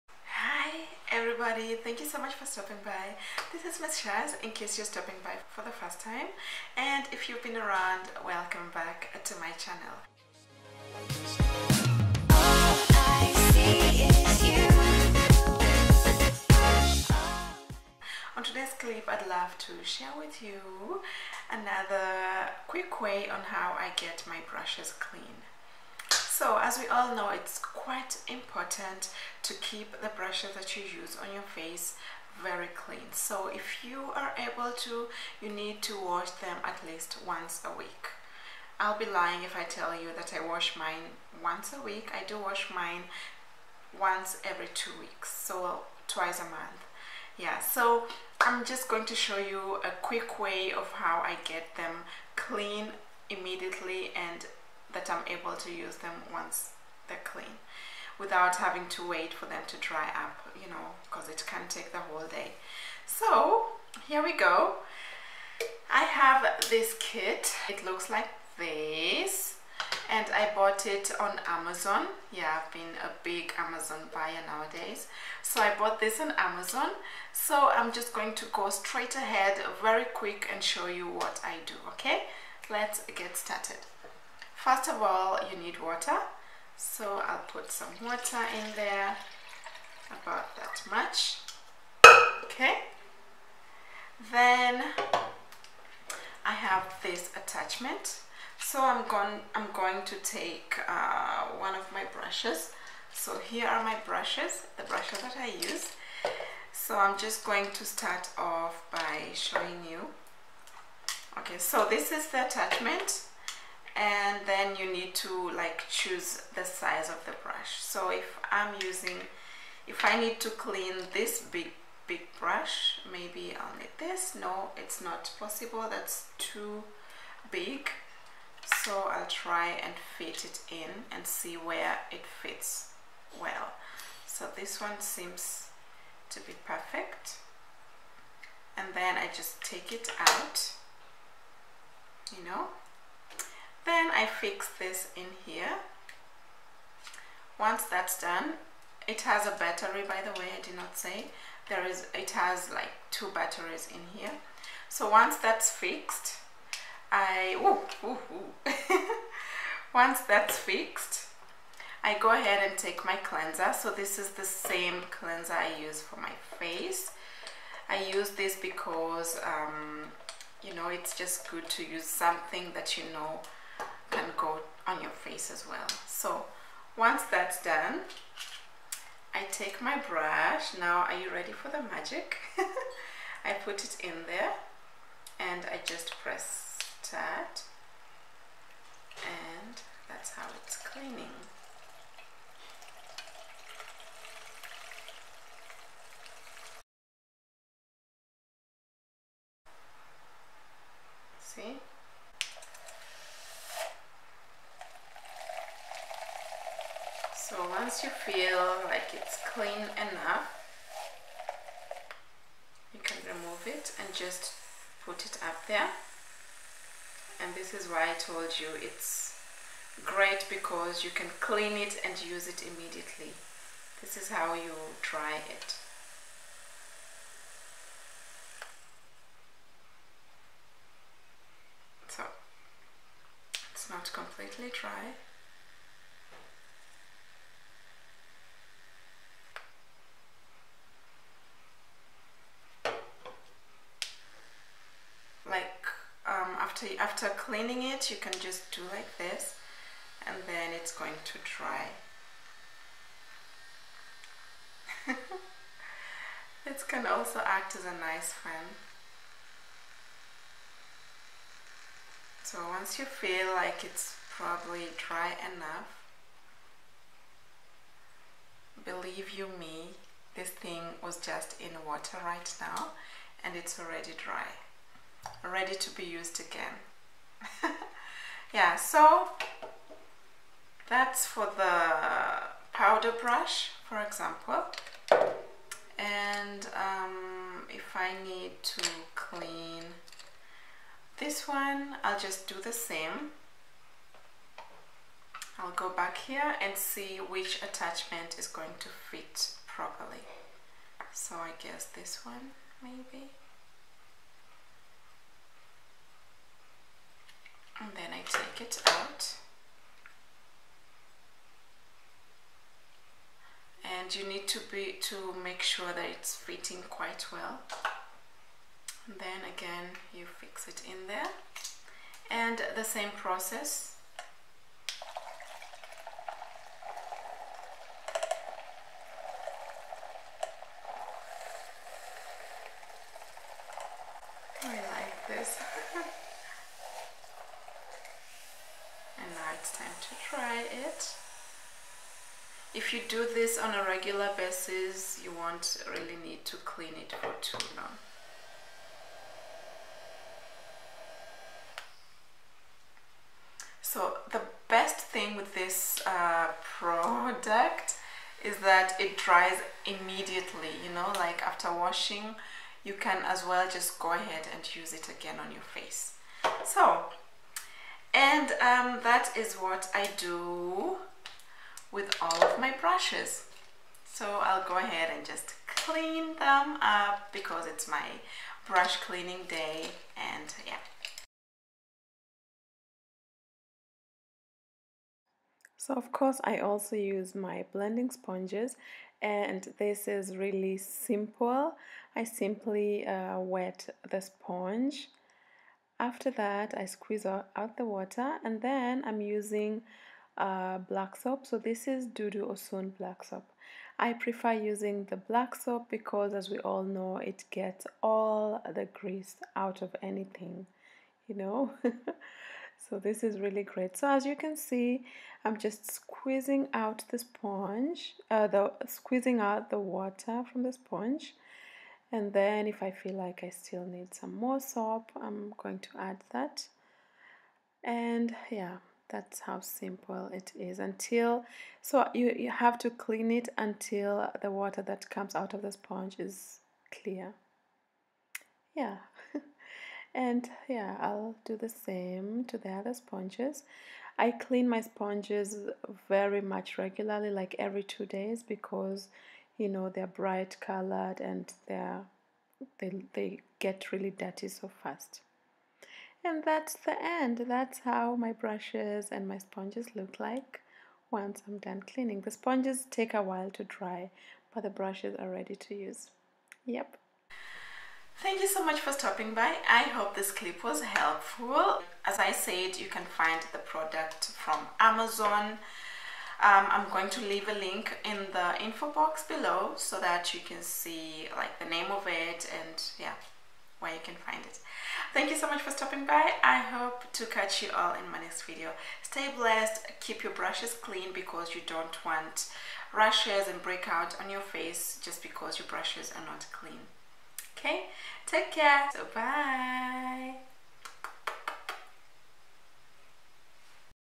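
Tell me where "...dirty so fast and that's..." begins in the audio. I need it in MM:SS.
07:34.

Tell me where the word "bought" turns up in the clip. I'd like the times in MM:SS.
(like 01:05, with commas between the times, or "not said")
01:10, 01:15.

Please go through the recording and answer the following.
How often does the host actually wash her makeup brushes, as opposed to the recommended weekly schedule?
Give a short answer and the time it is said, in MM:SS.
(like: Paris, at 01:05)
Every two weeks, at 00:43.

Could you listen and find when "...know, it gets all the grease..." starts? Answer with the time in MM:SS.
06:46.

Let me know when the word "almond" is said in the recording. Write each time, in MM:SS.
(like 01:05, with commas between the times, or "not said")
not said.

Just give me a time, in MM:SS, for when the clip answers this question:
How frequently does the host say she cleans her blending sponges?
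07:27.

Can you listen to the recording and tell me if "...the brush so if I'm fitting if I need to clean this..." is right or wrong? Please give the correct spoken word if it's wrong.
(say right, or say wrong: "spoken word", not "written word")
wrong: "using", not "fitting".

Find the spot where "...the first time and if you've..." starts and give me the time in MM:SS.
00:05.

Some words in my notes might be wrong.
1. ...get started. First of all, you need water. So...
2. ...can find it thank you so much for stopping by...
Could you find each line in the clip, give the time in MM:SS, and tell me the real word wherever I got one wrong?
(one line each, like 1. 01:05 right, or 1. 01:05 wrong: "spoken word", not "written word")
1. 01:23 right
2. 08:04 right.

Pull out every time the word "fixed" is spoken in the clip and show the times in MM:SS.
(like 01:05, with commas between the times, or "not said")
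02:35, 02:40.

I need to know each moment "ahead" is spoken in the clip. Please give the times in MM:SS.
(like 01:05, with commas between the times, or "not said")
01:19, 02:42, 06:04, 06:14.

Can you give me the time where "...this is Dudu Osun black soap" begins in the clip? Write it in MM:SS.
06:41.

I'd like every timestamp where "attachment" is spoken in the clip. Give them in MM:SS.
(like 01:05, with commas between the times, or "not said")
01:37, 01:52, 04:57.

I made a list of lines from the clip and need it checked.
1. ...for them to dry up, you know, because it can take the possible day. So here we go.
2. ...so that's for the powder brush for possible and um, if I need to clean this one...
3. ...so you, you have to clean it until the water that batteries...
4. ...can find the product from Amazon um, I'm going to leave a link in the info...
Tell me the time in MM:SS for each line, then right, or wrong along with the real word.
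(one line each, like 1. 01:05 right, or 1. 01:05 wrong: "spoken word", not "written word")
1. 00:59 wrong: "whole", not "possible"
2. 04:38 wrong: "example", not "possible"
3. 07:11 wrong: "comes", not "batteries"
4. 07:52 right.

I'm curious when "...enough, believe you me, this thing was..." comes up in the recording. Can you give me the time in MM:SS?
04:25.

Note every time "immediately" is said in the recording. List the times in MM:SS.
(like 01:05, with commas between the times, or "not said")
00:53, 03:42, 05:59.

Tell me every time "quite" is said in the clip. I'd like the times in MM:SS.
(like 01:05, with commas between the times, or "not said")
00:27, 05:16.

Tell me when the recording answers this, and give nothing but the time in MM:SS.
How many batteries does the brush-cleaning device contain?
02:33.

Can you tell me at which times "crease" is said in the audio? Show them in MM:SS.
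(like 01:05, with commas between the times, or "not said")
not said.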